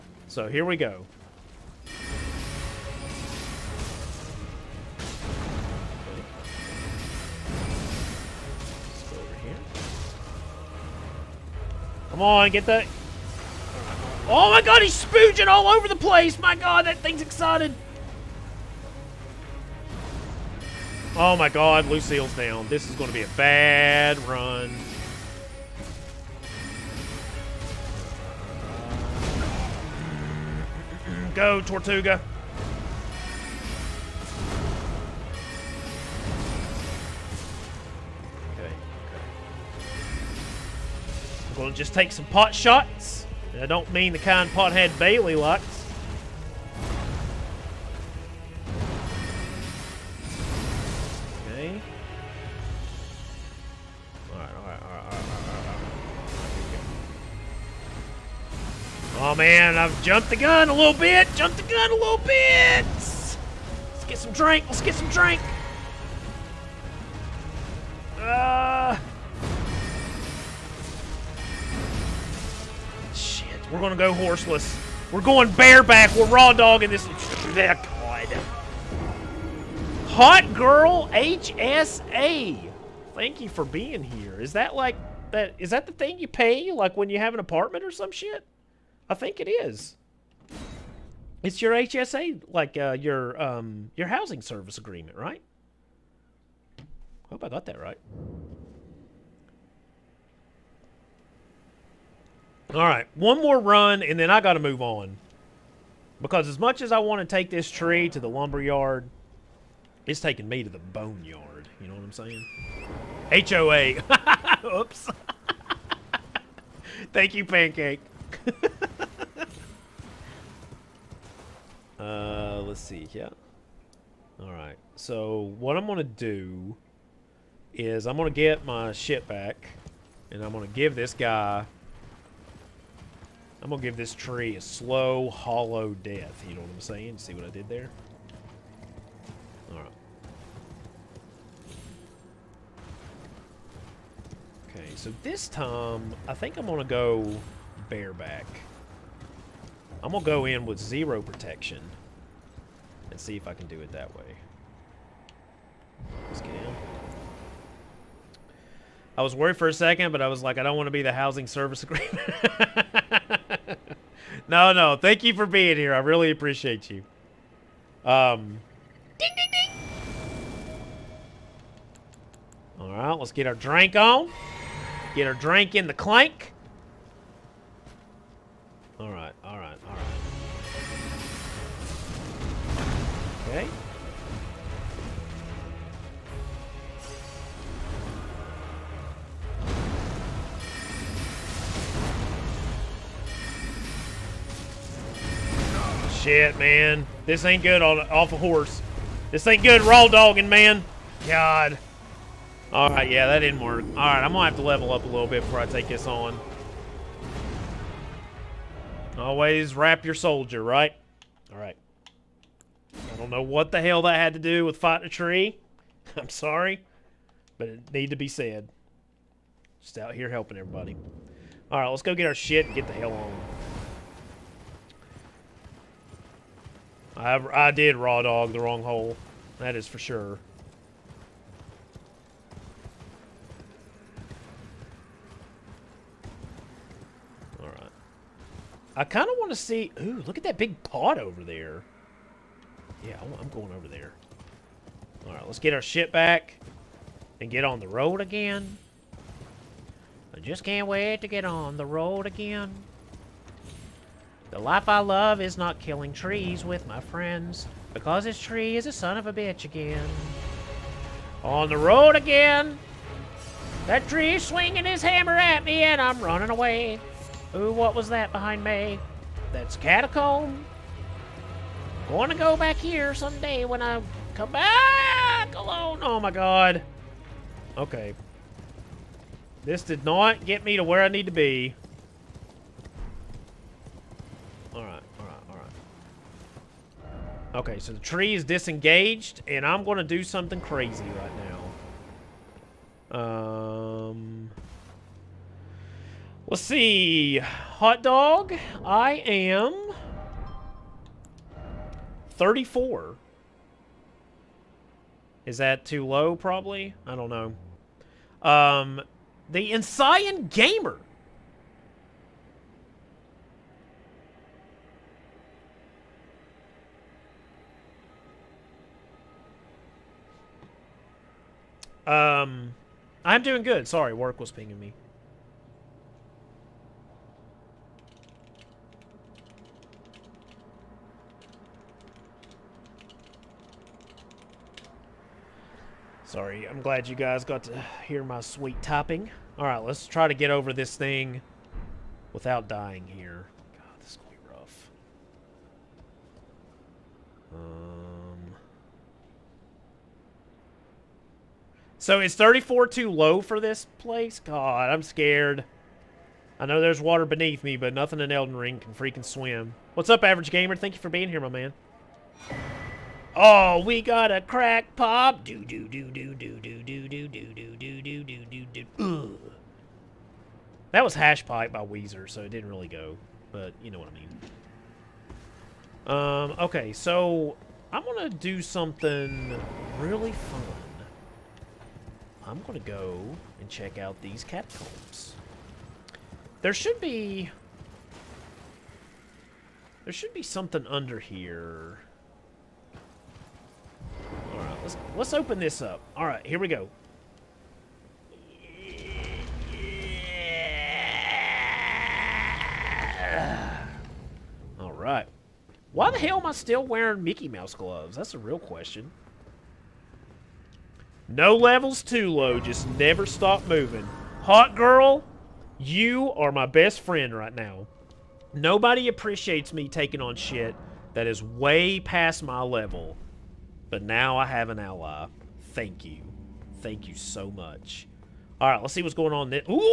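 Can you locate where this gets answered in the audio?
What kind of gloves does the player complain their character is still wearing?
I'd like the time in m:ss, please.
6:47.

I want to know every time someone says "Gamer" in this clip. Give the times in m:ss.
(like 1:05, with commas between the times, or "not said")
5:10, 6:00.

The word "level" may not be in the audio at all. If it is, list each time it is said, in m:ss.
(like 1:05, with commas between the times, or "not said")
3:24, 6:51, 7:02.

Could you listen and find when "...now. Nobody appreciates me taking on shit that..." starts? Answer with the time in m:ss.
6:57.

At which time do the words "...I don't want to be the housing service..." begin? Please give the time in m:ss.
2:40.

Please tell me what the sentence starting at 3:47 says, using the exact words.
I, I did raw dog the wrong hole.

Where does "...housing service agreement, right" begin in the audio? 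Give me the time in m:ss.
1:34.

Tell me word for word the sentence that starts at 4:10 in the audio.
I just can't wait to get on the road again.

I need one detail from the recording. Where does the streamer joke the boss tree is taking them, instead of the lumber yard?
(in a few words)
the boneyard.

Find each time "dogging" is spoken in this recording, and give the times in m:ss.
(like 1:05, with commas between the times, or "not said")
1:16, 3:20.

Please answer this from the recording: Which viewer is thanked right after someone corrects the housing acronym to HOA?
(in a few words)
Pancake.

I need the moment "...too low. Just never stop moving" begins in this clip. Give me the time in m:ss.
6:52.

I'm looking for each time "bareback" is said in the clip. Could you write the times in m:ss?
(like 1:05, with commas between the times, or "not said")
1:15, 2:27.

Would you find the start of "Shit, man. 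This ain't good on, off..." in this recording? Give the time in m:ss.
3:16.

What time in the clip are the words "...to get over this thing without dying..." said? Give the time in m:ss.
5:40.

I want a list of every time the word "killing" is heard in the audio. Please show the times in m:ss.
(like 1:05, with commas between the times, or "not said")
4:15.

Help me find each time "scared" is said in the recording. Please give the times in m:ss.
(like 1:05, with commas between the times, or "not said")
5:55.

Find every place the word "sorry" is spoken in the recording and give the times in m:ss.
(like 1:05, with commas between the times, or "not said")
3:36, 5:23, 5:36.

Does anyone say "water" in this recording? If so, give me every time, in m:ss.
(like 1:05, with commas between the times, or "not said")
5:57.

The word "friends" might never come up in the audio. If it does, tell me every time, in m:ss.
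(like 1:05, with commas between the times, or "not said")
4:16, 6:57.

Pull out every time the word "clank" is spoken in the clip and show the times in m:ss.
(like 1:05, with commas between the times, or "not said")
2:55.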